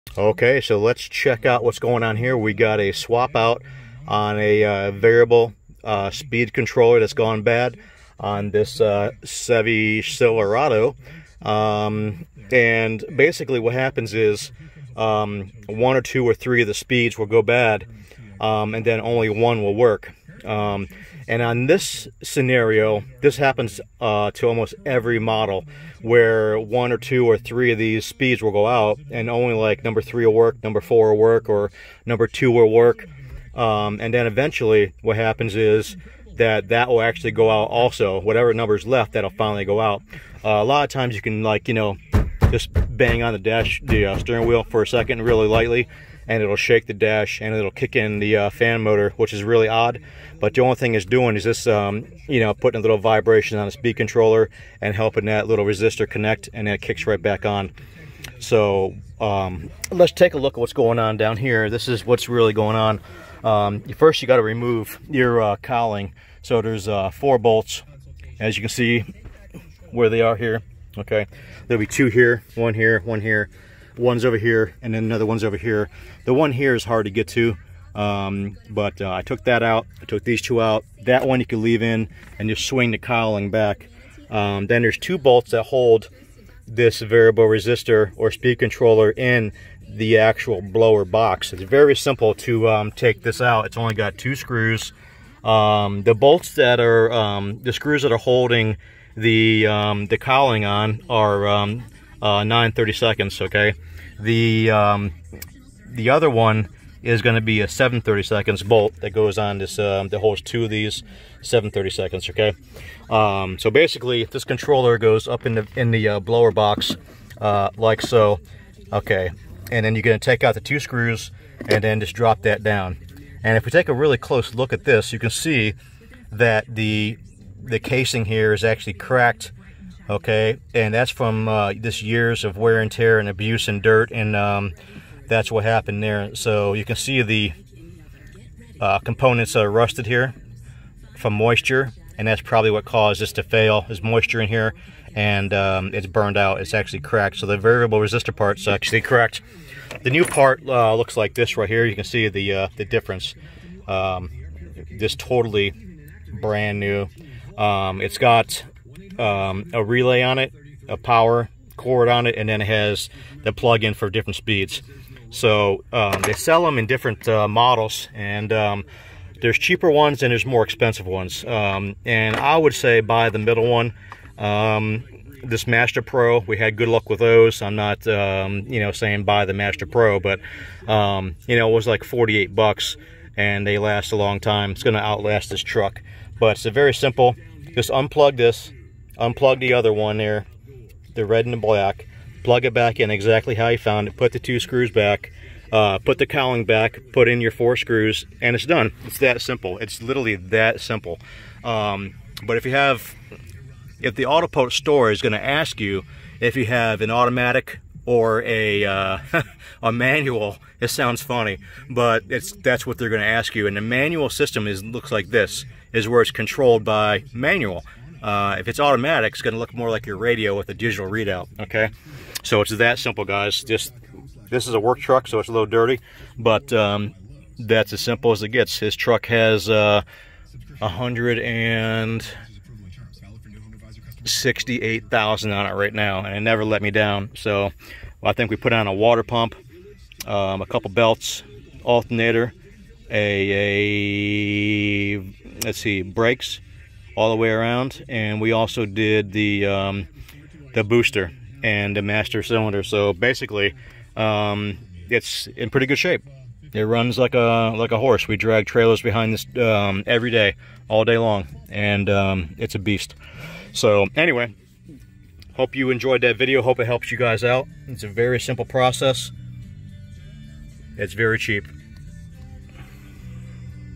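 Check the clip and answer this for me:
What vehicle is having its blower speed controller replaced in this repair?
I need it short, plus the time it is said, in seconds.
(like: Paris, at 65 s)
Chevy Silverado, at 9 s.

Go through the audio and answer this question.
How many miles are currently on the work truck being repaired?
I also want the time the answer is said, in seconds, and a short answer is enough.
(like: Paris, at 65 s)
168,000, at 230 s.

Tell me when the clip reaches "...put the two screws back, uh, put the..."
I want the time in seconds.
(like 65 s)
194 s.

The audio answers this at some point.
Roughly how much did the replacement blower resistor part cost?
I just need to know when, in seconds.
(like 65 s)
182 s.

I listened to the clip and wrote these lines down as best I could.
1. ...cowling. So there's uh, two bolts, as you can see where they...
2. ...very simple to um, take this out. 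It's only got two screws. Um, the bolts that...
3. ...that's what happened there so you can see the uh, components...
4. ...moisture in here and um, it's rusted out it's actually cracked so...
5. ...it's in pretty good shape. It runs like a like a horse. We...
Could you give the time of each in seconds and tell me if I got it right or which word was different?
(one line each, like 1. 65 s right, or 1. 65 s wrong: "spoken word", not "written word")
1. 65 s wrong: "four", not "two"
2. 91 s right
3. 135 s right
4. 144 s wrong: "burned", not "rusted"
5. 255 s right.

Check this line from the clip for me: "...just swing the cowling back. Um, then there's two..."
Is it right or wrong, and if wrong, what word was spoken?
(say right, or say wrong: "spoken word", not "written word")
right.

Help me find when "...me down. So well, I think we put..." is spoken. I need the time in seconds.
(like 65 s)
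236 s.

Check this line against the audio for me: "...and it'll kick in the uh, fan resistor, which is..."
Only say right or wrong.
wrong.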